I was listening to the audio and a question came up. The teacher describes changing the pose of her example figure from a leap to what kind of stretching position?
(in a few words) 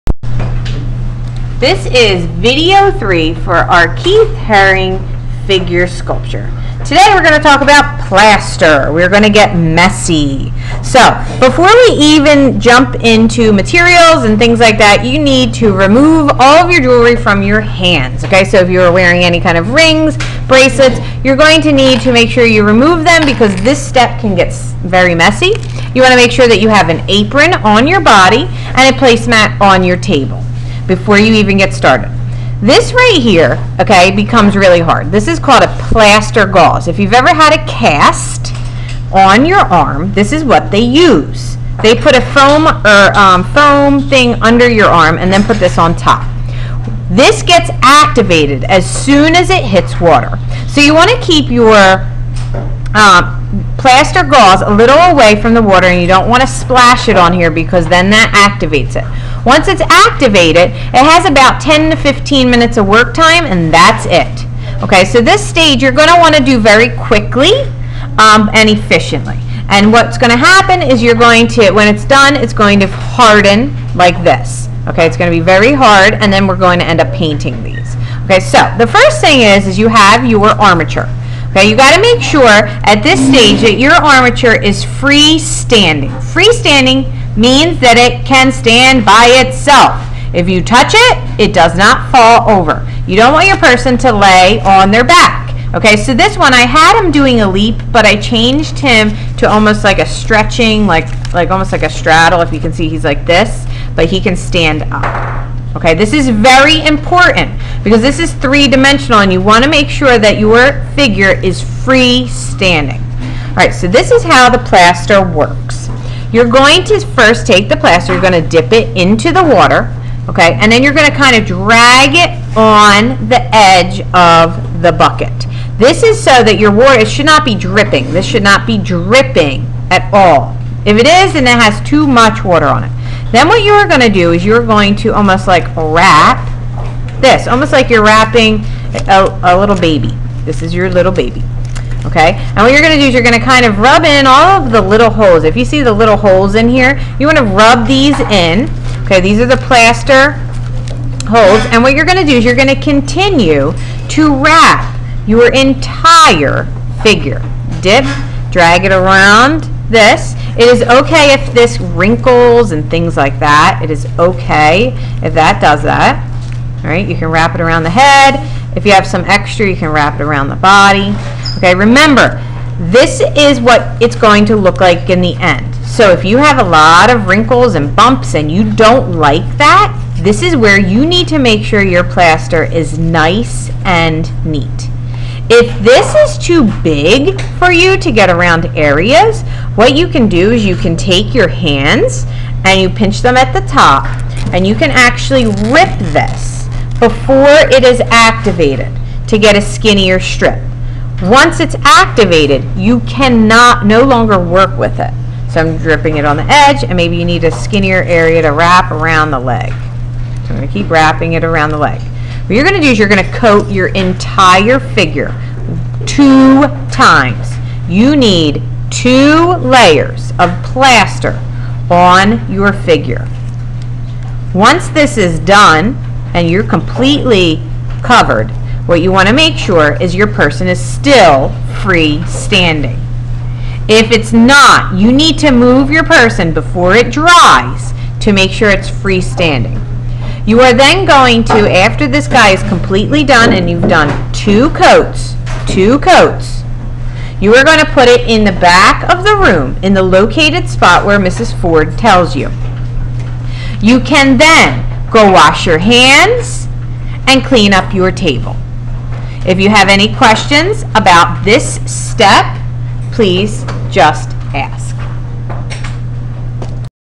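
a straddle.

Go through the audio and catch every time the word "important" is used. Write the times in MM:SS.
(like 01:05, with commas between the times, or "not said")
01:46.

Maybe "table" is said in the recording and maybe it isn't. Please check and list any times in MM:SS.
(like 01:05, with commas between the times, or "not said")
00:29, 04:18.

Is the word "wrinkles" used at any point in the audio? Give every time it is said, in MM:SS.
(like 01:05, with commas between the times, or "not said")
02:41, 02:57.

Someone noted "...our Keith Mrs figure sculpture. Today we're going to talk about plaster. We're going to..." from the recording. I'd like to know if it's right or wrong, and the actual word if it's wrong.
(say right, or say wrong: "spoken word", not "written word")
wrong: "Haring", not "Mrs".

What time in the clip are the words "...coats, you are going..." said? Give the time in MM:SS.
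04:05.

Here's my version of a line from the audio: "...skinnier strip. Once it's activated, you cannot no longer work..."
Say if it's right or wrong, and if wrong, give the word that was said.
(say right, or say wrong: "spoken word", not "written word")
right.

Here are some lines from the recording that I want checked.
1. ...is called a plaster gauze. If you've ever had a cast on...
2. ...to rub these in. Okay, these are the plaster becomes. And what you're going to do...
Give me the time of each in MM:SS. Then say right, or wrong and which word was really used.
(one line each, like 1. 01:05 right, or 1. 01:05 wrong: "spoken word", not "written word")
1. 00:35 right
2. 02:27 wrong: "holes", not "becomes".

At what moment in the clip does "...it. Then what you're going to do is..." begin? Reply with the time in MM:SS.
02:12.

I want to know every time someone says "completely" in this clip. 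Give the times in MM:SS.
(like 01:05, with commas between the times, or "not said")
03:46, 04:02.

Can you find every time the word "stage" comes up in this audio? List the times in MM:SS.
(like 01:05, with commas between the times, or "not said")
01:05, 01:23.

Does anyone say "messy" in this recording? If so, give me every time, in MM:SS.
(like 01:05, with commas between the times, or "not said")
00:09, 00:25.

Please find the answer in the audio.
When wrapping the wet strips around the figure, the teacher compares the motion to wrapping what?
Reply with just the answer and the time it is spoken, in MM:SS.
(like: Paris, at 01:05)
a little baby, at 02:19.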